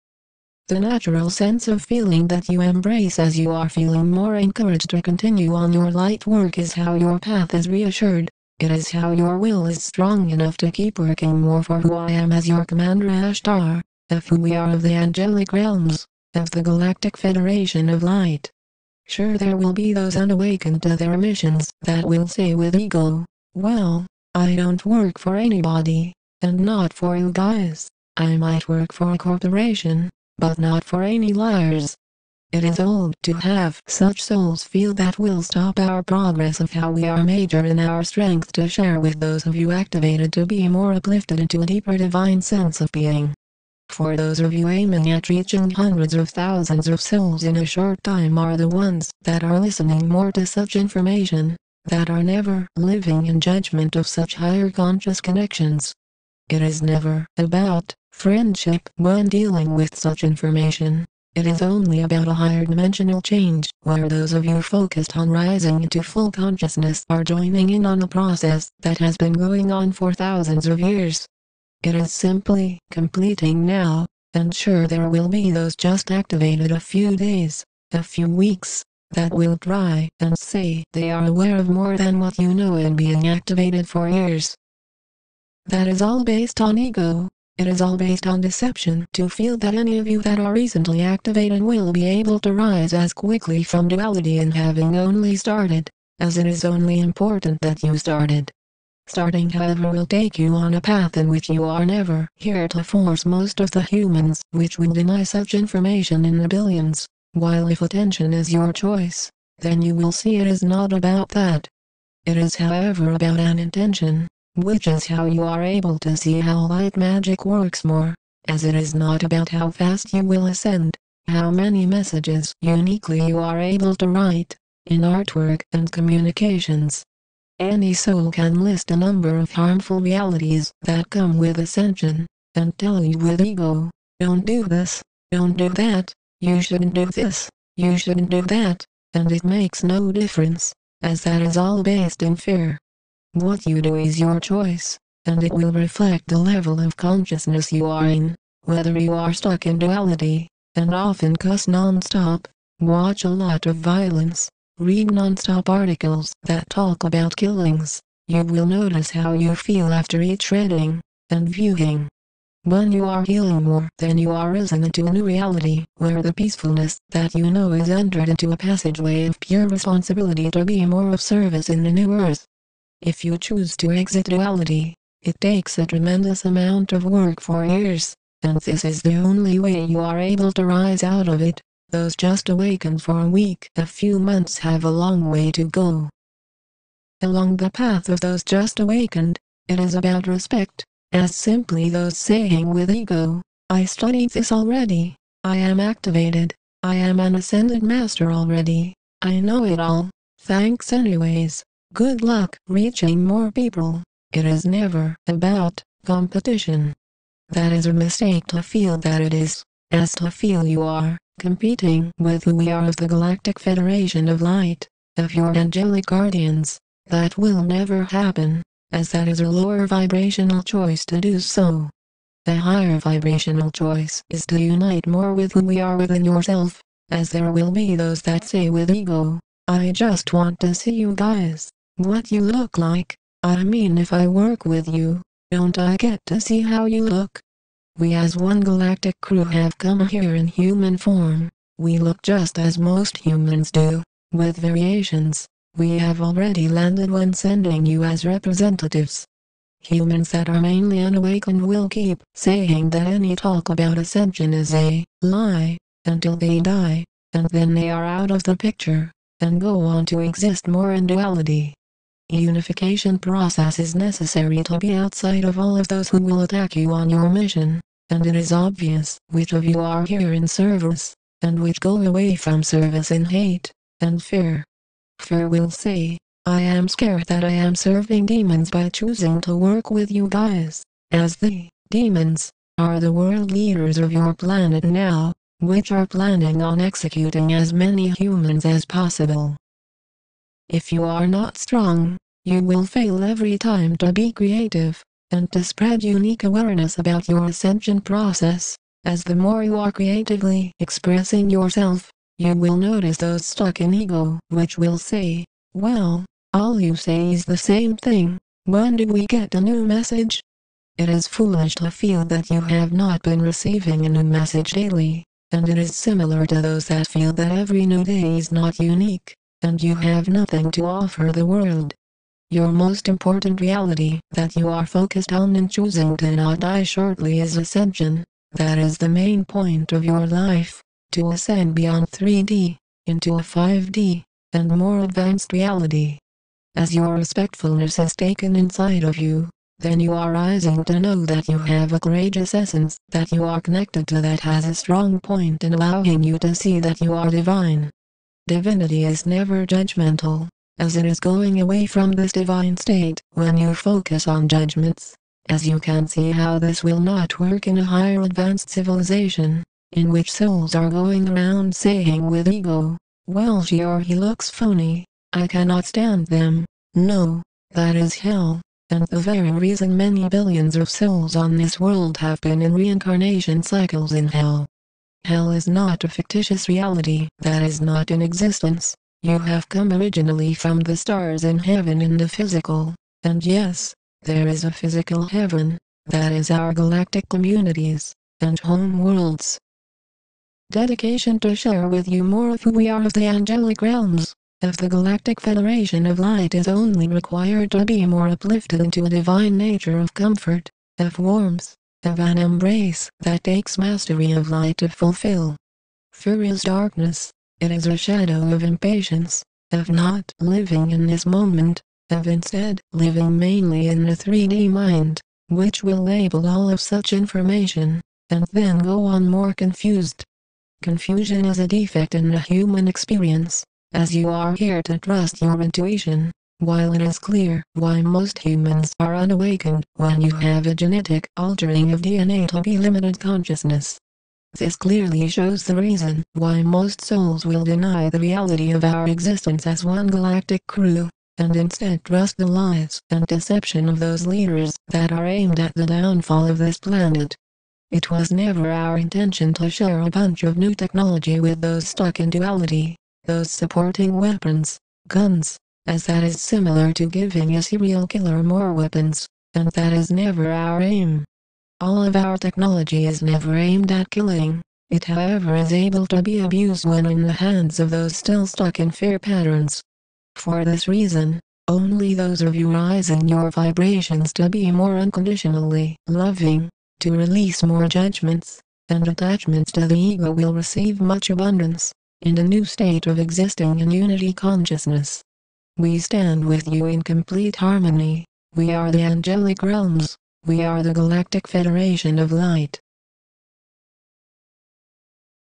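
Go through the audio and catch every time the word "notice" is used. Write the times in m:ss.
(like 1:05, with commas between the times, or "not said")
2:38, 5:02.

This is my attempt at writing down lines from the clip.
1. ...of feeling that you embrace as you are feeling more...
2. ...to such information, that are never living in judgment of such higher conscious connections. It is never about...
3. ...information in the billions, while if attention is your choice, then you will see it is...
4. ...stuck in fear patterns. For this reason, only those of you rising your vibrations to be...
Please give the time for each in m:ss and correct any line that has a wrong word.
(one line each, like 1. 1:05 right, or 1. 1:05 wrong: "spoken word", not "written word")
1. 0:01 right
2. 0:50 right
3. 1:45 right
4. 7:48 right.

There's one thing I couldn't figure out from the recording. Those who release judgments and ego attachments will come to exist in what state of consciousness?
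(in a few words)
unity consciousness.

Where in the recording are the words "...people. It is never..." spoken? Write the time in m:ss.
3:23.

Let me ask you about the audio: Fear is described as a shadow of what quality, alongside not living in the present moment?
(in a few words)
impatience.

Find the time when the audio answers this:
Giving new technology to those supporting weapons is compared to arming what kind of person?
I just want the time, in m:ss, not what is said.
7:37.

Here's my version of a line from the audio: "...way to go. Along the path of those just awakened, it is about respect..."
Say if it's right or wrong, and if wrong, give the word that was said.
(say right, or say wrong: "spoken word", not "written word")
right.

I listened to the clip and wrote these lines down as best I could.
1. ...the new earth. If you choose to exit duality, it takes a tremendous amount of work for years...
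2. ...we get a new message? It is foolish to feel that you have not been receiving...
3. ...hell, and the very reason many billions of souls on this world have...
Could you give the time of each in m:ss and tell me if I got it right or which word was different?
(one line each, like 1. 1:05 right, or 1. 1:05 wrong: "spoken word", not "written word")
1. 2:51 right
2. 5:09 right
3. 6:08 right.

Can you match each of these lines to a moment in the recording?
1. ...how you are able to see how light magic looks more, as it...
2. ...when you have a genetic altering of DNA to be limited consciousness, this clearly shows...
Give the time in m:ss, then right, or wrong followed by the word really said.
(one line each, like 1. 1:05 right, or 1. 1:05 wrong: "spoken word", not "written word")
1. 1:55 wrong: "works", not "looks"
2. 7:09 right.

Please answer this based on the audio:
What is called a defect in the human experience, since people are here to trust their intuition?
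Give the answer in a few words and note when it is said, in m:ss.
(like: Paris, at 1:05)
Confusion, at 7:00.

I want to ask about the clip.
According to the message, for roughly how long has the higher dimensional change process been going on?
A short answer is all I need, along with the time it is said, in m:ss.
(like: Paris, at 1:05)
thousands of years, at 1:10.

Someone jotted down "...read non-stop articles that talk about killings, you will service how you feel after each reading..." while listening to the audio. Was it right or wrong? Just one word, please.
wrong.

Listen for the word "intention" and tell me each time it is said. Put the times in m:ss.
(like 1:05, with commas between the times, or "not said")
1:53, 7:28.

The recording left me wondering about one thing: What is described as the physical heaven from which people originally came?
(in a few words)
galactic communities and home worlds.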